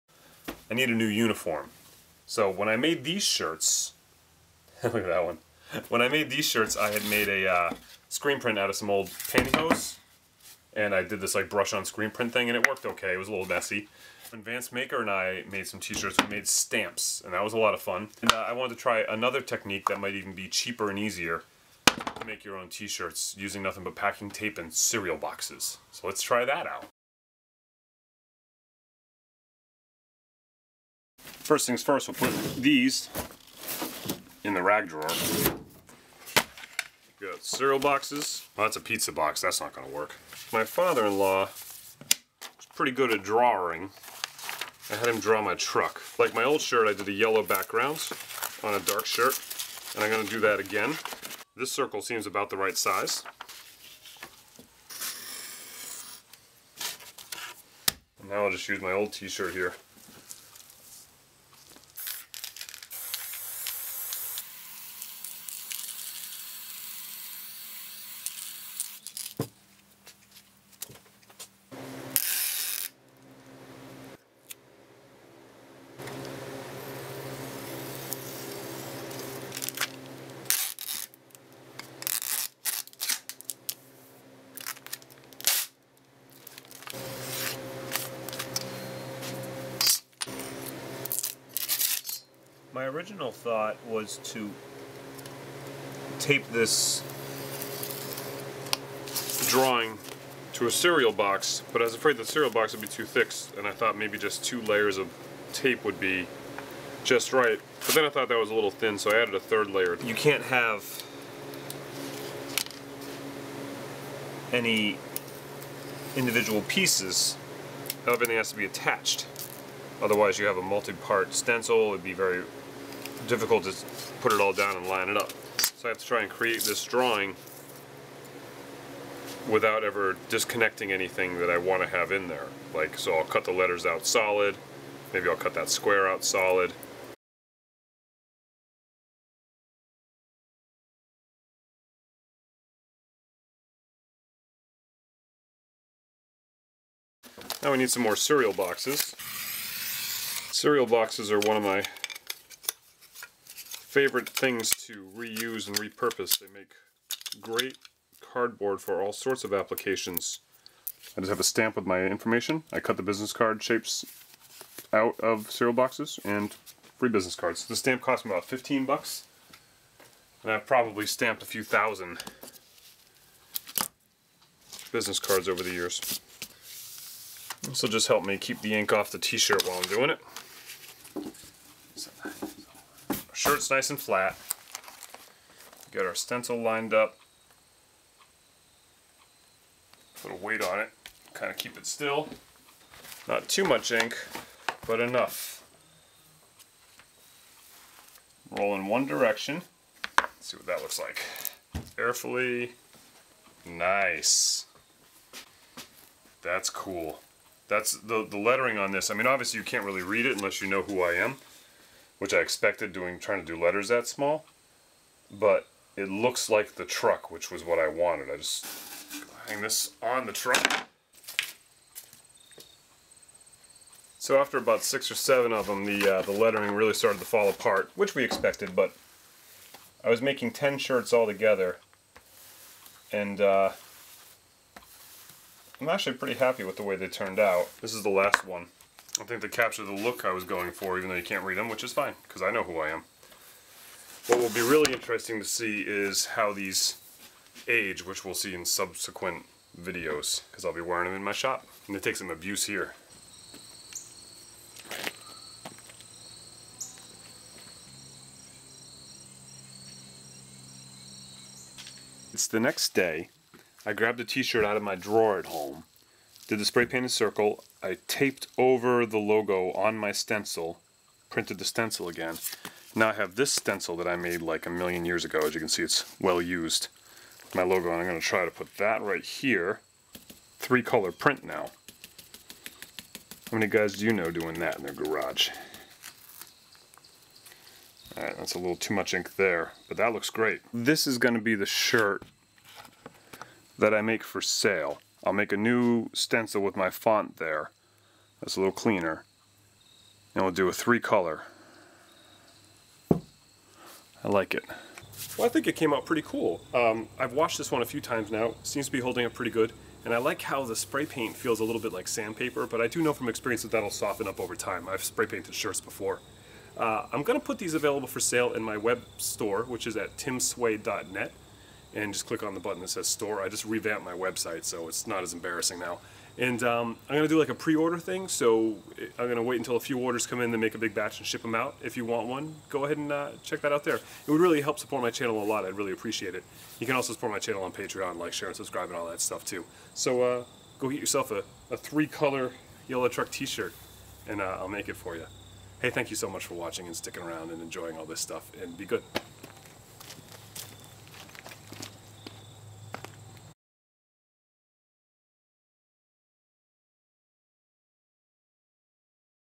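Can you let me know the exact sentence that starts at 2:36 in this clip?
They make great cardboard for all sorts of applications.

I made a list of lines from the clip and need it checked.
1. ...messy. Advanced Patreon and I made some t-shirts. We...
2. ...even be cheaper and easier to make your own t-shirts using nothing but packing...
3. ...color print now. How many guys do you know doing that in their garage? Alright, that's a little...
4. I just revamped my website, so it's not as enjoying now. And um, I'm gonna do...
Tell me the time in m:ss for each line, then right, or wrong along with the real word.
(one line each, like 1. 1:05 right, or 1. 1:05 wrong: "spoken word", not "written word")
1. 0:13 wrong: "Maker", not "Patreon"
2. 0:20 right
3. 4:40 right
4. 5:23 wrong: "embarrassing", not "enjoying".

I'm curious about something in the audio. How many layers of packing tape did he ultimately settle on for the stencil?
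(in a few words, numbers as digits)
3.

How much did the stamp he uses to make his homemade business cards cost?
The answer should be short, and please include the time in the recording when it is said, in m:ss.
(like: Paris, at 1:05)
15 bucks, at 2:48.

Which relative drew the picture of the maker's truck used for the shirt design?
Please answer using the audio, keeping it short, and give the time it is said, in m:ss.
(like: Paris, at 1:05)
father-in-law, at 0:40.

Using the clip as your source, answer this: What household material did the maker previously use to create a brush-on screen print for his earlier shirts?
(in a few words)
pantyhose.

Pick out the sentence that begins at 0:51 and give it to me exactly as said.
This circle seems about the right size.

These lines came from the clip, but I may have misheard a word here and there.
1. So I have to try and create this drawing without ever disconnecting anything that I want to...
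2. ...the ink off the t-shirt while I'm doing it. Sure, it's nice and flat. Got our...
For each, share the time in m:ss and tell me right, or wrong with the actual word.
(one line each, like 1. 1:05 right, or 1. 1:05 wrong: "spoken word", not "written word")
1. 2:05 right
2. 2:58 right.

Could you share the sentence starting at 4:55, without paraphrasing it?
I'll make a new stencil with my font there.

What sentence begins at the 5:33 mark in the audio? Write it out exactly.
It would really help support my channel a lot.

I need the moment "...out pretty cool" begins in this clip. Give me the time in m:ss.
5:05.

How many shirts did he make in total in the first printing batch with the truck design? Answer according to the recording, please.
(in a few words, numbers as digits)
10.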